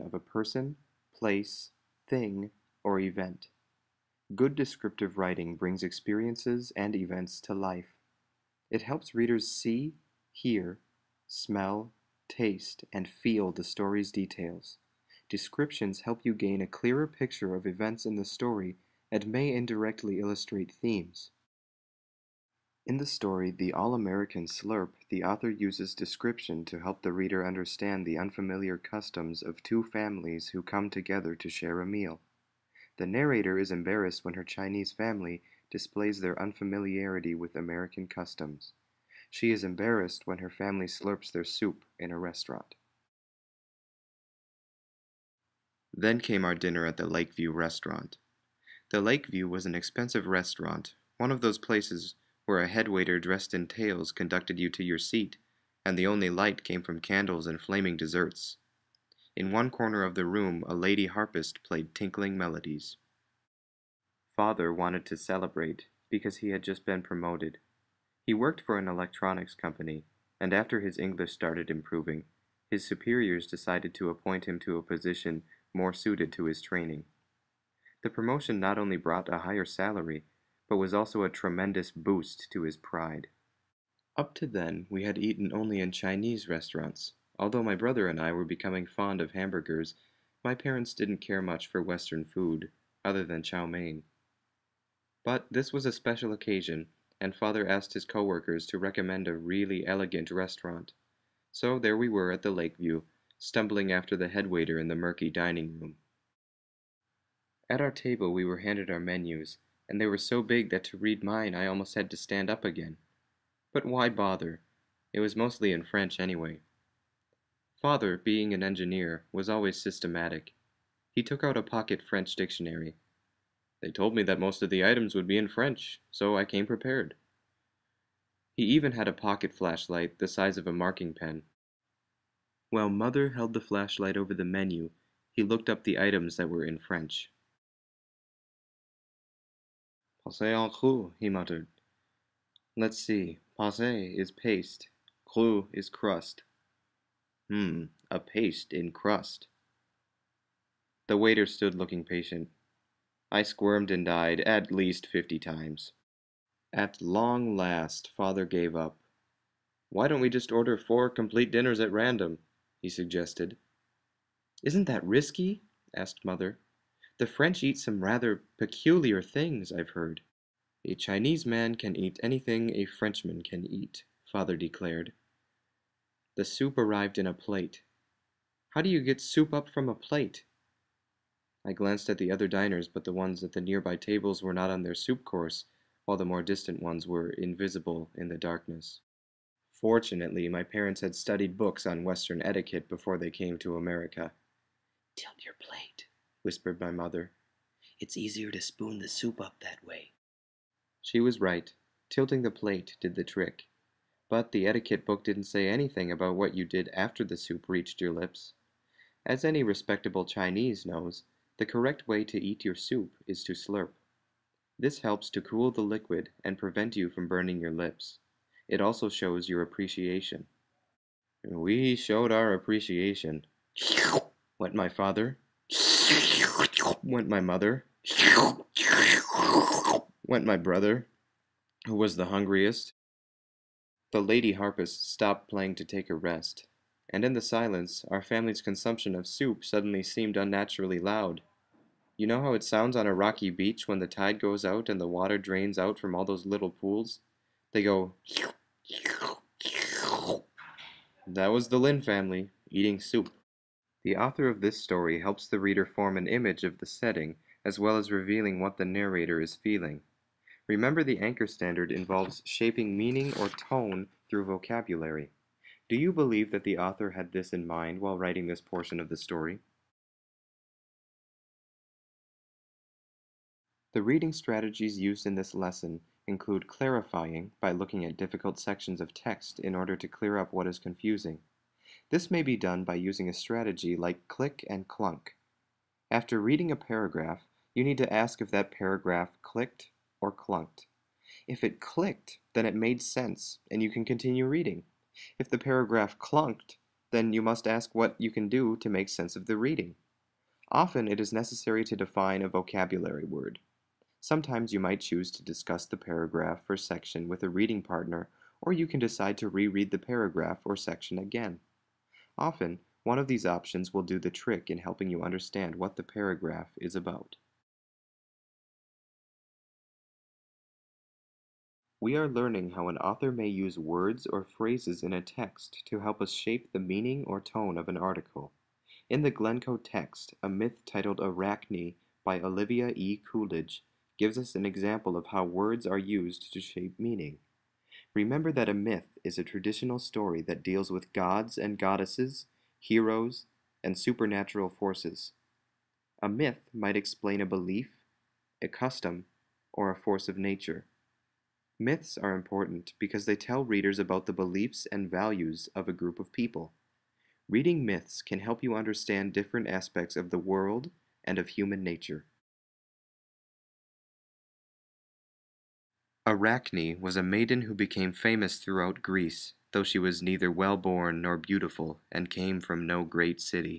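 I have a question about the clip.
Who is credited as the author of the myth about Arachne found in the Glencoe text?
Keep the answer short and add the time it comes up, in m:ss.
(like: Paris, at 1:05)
Olivia E. Coolidge, at 5:32.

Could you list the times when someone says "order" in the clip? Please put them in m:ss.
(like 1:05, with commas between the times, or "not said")
2:40, 4:39.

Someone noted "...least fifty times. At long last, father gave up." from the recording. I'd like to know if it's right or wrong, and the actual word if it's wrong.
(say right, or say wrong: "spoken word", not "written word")
right.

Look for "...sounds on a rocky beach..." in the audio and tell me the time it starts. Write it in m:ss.
4:02.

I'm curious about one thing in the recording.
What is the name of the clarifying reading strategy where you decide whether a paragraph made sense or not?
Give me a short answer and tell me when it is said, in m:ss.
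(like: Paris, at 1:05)
click and clunk, at 4:44.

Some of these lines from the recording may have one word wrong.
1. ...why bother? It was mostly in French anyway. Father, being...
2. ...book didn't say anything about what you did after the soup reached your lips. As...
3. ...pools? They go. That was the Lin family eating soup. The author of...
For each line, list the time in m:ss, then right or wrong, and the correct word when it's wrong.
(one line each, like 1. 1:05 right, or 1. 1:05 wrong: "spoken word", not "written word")
1. 1:53 right
2. 3:25 right
3. 4:06 right.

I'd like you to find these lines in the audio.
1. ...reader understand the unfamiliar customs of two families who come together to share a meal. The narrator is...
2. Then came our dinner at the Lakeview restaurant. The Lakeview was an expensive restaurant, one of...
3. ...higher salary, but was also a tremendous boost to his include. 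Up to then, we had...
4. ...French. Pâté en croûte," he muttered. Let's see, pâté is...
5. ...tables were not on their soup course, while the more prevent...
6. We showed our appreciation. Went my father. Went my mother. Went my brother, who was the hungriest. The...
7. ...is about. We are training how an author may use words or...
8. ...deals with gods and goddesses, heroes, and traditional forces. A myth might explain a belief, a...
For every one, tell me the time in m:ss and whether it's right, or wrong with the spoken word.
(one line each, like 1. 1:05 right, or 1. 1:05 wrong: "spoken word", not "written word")
1. 0:27 right
2. 0:45 right
3. 1:19 wrong: "pride", not "include"
4. 2:16 right
5. 3:03 wrong: "distant", not "prevent"
6. 3:41 right
7. 5:16 wrong: "learning", not "training"
8. 5:40 wrong: "supernatural", not "traditional".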